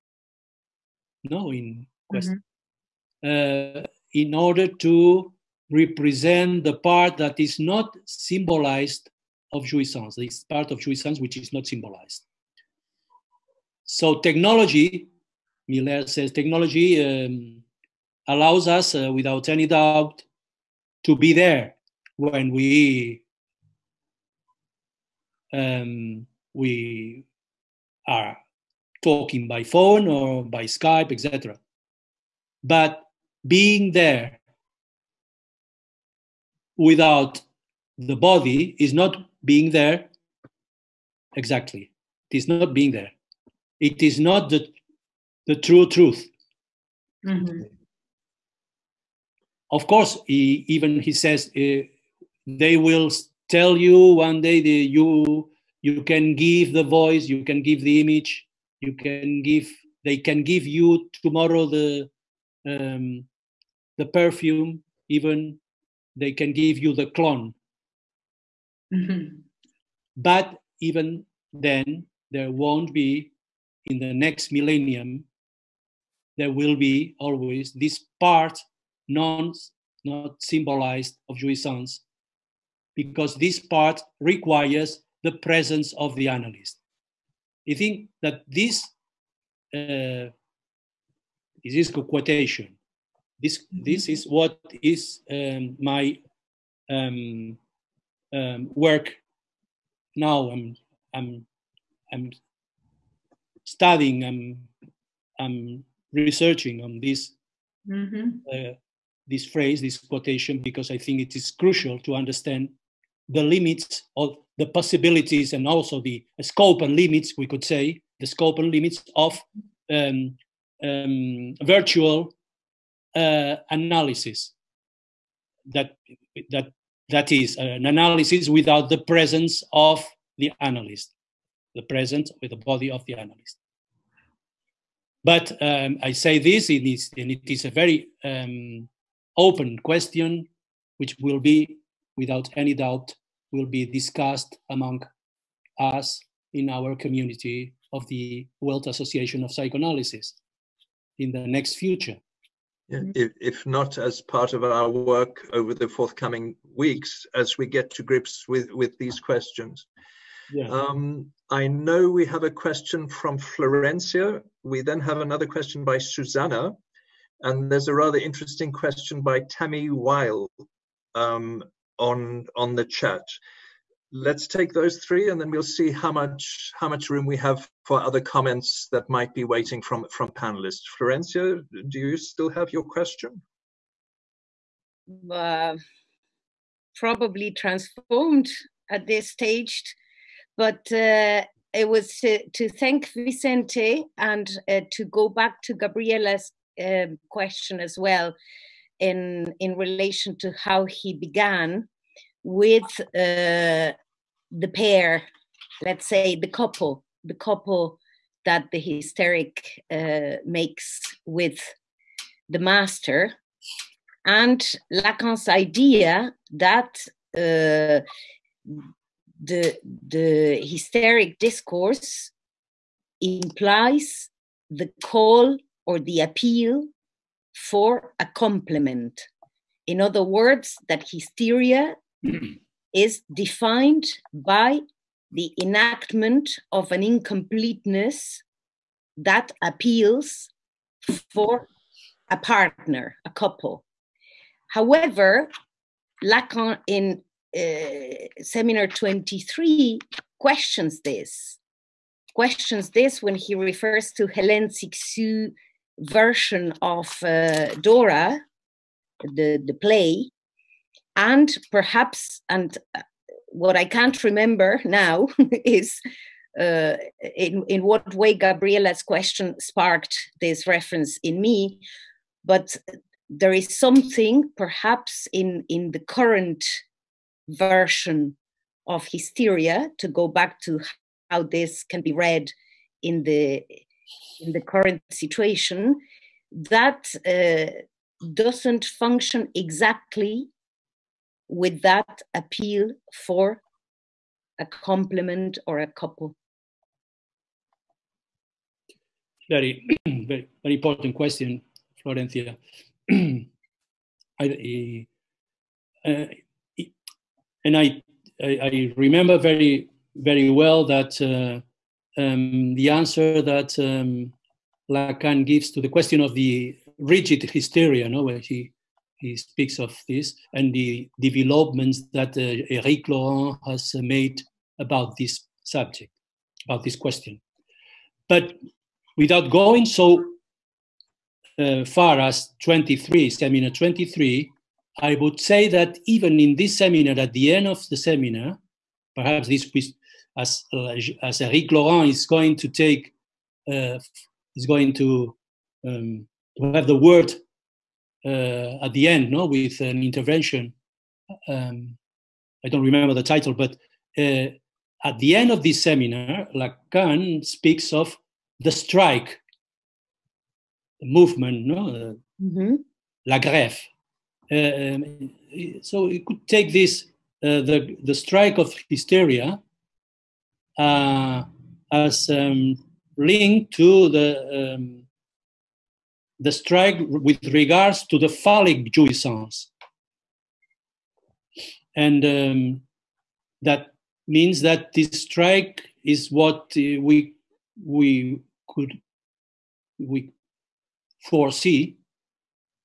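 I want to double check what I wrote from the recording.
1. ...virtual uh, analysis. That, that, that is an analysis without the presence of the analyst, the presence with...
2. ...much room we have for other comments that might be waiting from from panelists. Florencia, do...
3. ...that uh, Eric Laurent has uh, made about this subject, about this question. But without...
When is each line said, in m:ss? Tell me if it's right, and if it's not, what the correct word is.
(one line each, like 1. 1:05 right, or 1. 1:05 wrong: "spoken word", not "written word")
1. 2:01 right
2. 2:56 right
3. 5:22 right.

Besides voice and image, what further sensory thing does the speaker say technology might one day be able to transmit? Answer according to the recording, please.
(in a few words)
perfume.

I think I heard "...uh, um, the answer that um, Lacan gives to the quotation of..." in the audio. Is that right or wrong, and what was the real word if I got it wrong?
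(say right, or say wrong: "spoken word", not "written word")
wrong: "question", not "quotation".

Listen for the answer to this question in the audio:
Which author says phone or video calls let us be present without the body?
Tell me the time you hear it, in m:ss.
0:15.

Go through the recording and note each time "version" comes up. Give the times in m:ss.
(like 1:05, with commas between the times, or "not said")
4:15, 4:37.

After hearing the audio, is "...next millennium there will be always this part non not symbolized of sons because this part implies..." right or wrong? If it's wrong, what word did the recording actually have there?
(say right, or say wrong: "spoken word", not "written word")
wrong: "requires", not "implies".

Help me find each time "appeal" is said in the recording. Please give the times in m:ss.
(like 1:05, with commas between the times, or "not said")
3:46, 3:59, 4:52.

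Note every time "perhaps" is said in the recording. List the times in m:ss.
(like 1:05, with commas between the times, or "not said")
4:21, 4:34, 5:39.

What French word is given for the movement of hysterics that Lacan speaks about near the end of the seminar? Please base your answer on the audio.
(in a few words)
la grève.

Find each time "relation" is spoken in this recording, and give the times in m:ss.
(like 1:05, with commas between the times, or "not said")
3:19.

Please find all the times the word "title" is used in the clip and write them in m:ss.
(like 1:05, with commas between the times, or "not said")
5:53.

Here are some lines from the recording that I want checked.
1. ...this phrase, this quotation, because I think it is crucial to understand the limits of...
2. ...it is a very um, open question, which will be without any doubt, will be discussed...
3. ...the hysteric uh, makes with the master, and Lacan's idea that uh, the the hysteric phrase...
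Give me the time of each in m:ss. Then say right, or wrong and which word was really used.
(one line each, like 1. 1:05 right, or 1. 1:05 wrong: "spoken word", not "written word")
1. 1:49 right
2. 2:17 right
3. 3:28 wrong: "discourse", not "phrase".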